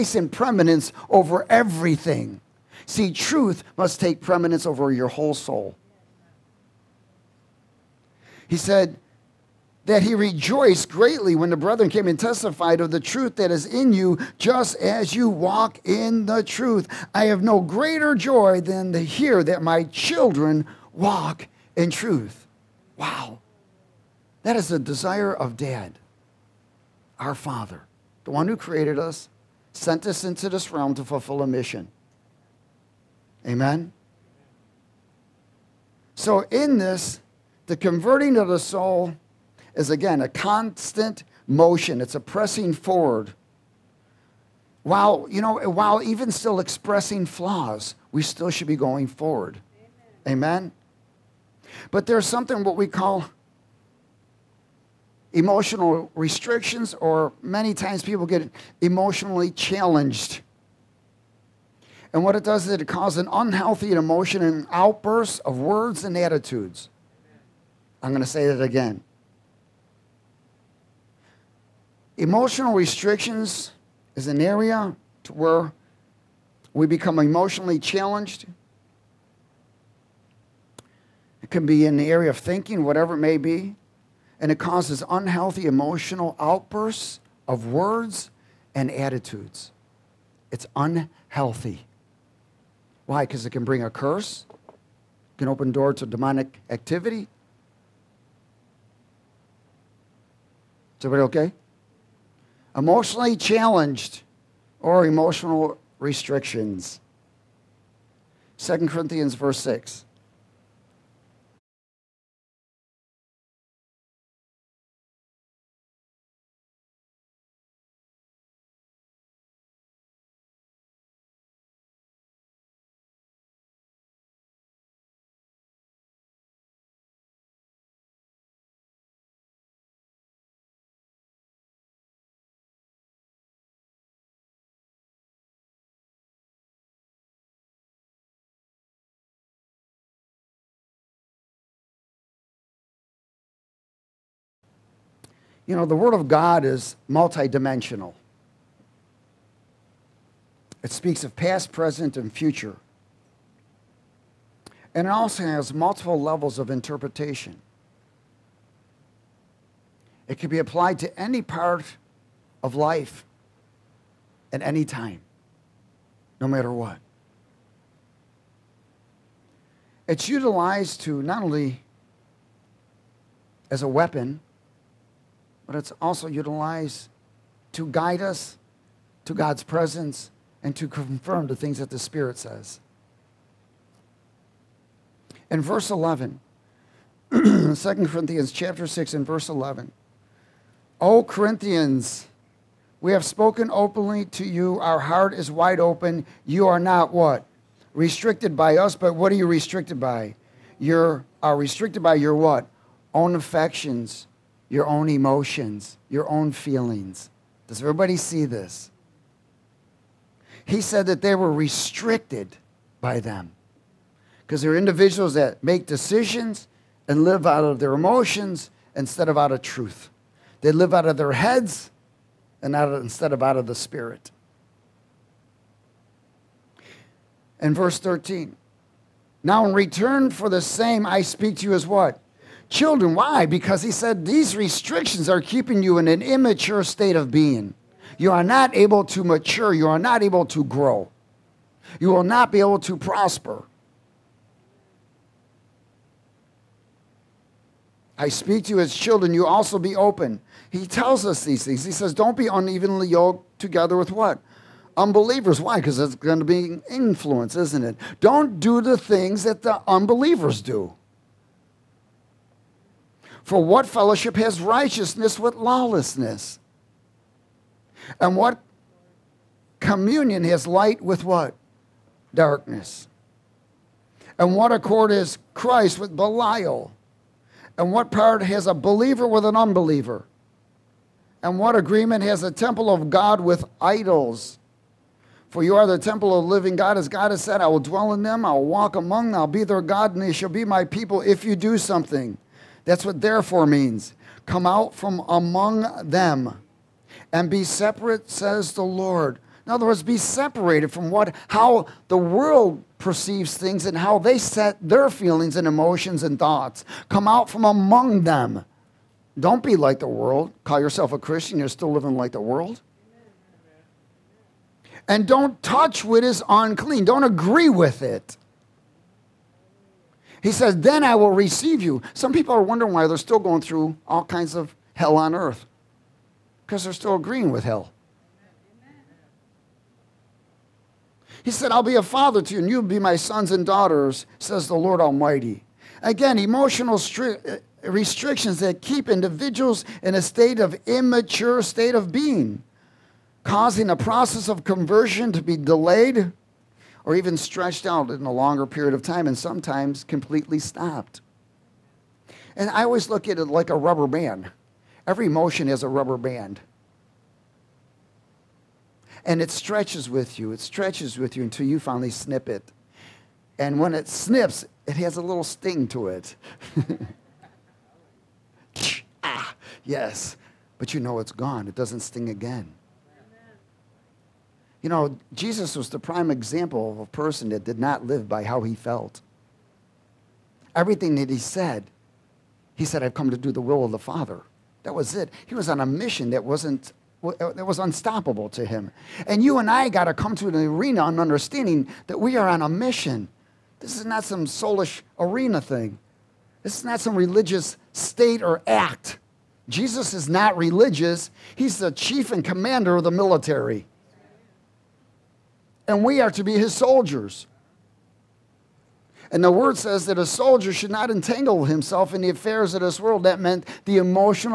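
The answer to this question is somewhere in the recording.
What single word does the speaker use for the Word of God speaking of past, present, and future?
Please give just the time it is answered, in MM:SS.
02:27.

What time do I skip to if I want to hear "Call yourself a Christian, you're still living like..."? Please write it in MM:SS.
05:10.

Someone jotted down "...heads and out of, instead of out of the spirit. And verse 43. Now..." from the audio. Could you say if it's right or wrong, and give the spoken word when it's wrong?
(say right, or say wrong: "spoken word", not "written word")
wrong: "13", not "43".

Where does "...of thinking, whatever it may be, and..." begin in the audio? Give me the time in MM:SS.
01:22.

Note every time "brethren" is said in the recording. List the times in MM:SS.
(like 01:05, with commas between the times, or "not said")
00:11.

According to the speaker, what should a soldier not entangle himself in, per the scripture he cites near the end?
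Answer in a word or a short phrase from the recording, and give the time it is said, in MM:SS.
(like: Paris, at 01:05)
Affairs of this world, at 06:52.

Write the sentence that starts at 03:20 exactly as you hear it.
You are restricted by your what?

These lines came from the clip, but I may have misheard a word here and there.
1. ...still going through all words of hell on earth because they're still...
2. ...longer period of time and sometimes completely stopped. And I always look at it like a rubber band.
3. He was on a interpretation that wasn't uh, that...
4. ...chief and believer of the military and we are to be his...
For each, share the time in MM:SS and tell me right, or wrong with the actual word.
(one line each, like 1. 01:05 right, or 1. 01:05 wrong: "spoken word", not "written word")
1. 05:23 wrong: "kinds", not "words"
2. 05:48 right
3. 06:25 wrong: "mission", not "interpretation"
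4. 06:41 wrong: "commander", not "believer".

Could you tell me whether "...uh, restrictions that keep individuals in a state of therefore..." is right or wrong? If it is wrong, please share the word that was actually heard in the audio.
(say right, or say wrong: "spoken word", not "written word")
wrong: "immature", not "therefore".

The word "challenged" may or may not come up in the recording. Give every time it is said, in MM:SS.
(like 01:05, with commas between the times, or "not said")
00:59, 01:17, 01:43.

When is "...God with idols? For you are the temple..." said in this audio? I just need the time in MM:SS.
04:43.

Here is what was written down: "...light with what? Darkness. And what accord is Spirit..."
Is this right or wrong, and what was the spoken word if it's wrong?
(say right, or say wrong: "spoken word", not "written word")
wrong: "Christ", not "Spirit".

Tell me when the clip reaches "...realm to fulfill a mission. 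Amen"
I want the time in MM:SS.
00:30.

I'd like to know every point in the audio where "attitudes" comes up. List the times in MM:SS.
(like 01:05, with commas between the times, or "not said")
01:06, 01:28.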